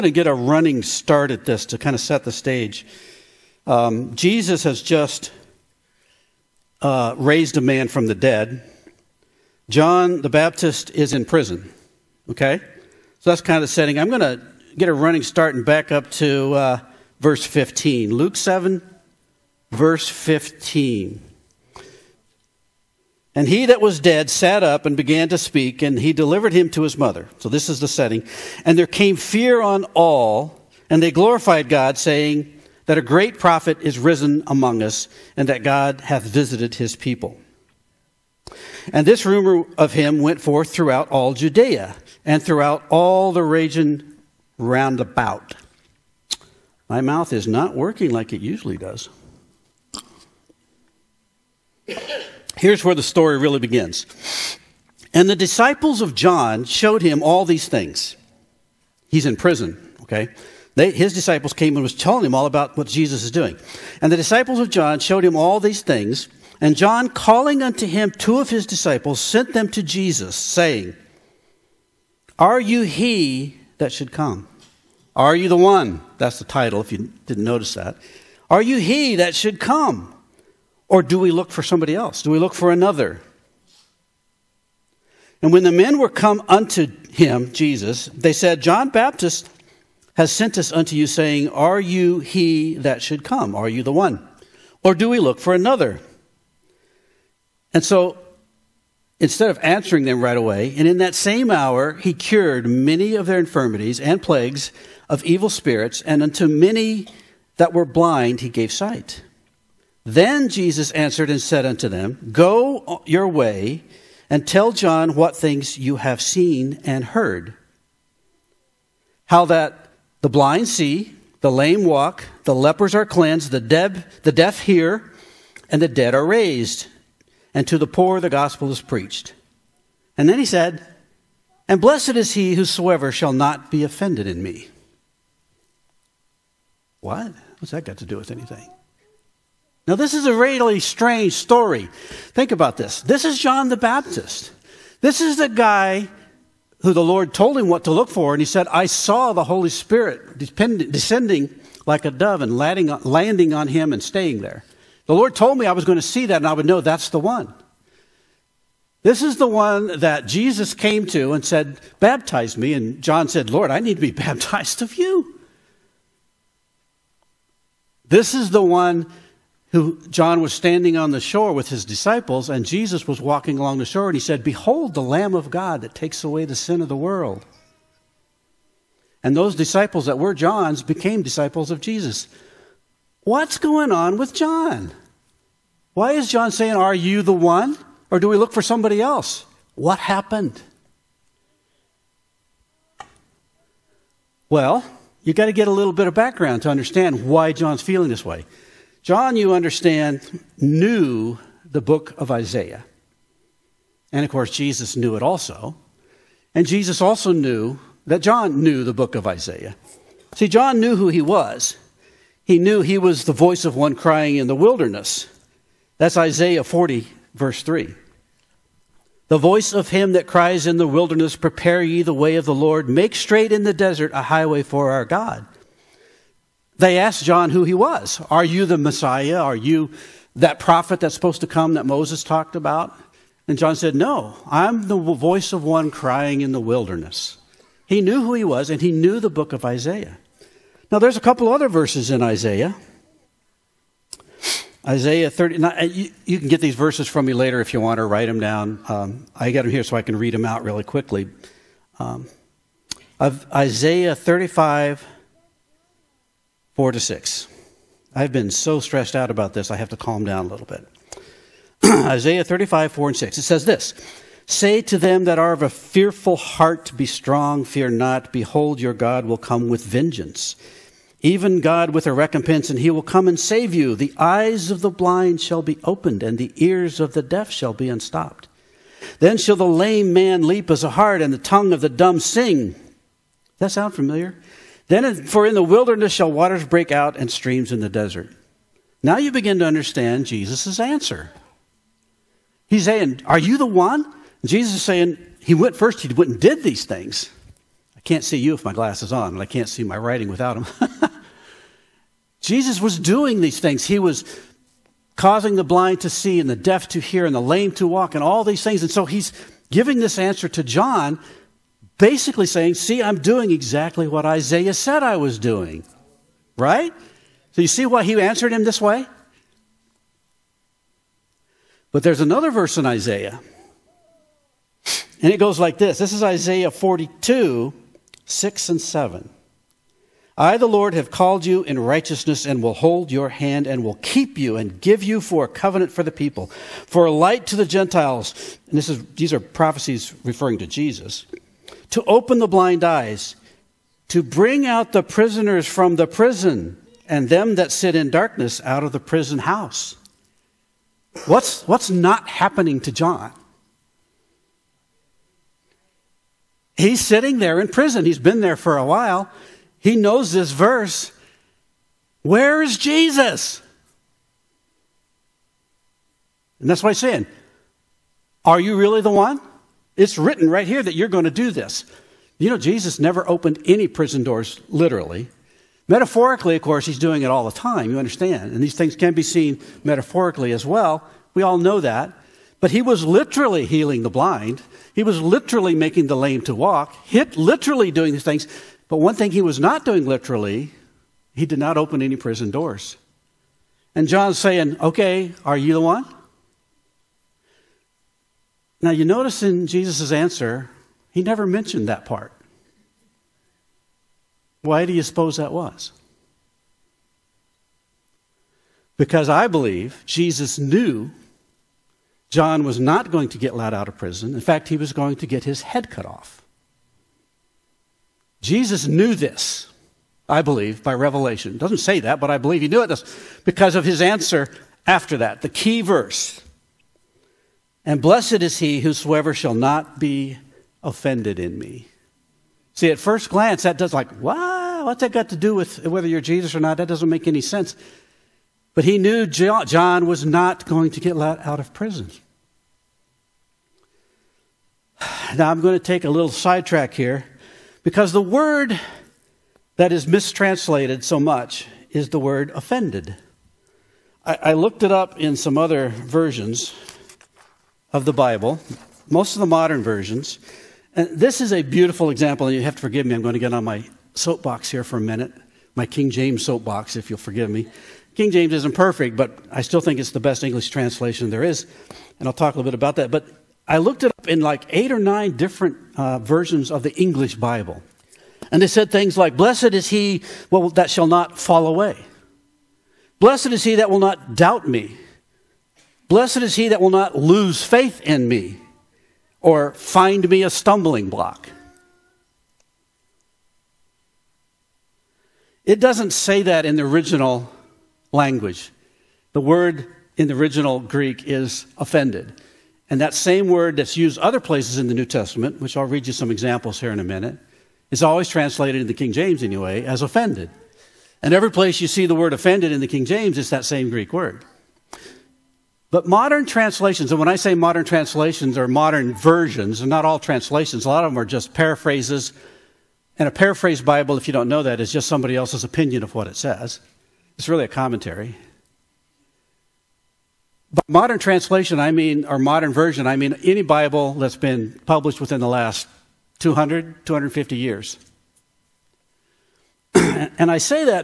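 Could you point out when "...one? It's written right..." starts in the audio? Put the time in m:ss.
6:09.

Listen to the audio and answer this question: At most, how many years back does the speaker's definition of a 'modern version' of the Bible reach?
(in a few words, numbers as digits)
250.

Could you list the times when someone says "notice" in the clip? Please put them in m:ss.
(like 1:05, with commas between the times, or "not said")
1:17, 6:39.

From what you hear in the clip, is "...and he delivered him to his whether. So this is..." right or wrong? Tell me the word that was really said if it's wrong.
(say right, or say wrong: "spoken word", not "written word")
wrong: "mother", not "whether".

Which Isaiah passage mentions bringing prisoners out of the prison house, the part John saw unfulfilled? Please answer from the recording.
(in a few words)
Isaiah 42:6-7.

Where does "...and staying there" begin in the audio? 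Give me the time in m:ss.
2:33.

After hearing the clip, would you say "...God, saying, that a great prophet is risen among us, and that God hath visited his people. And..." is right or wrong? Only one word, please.
right.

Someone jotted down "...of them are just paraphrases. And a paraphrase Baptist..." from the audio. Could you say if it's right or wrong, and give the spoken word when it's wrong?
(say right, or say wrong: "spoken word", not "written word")
wrong: "Bible", not "Baptist".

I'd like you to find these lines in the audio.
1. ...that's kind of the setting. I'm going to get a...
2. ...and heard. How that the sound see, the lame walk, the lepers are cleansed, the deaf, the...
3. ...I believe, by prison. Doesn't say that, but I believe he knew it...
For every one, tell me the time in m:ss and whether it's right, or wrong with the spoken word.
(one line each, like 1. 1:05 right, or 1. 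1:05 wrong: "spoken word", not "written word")
1. 0:13 right
2. 1:56 wrong: "blind", not "sound"
3. 7:00 wrong: "revelation", not "prison".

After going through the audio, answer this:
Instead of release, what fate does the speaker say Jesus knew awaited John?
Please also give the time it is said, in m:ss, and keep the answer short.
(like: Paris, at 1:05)
His head cut off, at 6:55.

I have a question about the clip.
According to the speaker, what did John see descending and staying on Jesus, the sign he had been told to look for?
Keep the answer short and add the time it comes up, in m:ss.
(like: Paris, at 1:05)
The Holy Spirit, at 2:29.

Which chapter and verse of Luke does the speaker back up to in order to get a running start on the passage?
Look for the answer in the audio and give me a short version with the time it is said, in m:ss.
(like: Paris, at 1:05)
Luke 7:15, at 0:18.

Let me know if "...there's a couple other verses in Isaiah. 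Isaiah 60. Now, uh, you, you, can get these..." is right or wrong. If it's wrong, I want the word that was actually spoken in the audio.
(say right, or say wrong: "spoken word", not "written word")
wrong: "30", not "60".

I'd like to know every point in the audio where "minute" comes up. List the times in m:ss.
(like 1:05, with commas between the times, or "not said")
7:45, 8:27.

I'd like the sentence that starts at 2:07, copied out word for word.
And to the poor the gospel is preached.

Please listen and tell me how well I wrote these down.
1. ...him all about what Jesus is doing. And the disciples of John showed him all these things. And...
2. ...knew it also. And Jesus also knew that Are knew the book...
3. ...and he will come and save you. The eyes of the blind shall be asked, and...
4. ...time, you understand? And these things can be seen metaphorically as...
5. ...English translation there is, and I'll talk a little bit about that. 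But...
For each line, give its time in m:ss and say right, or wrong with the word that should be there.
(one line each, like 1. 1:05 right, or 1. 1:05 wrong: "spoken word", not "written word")
1. 1:02 right
2. 3:24 wrong: "John", not "Are"
3. 4:32 wrong: "opened", not "asked"
4. 6:17 right
5. 7:50 right.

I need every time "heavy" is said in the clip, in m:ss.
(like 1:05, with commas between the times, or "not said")
not said.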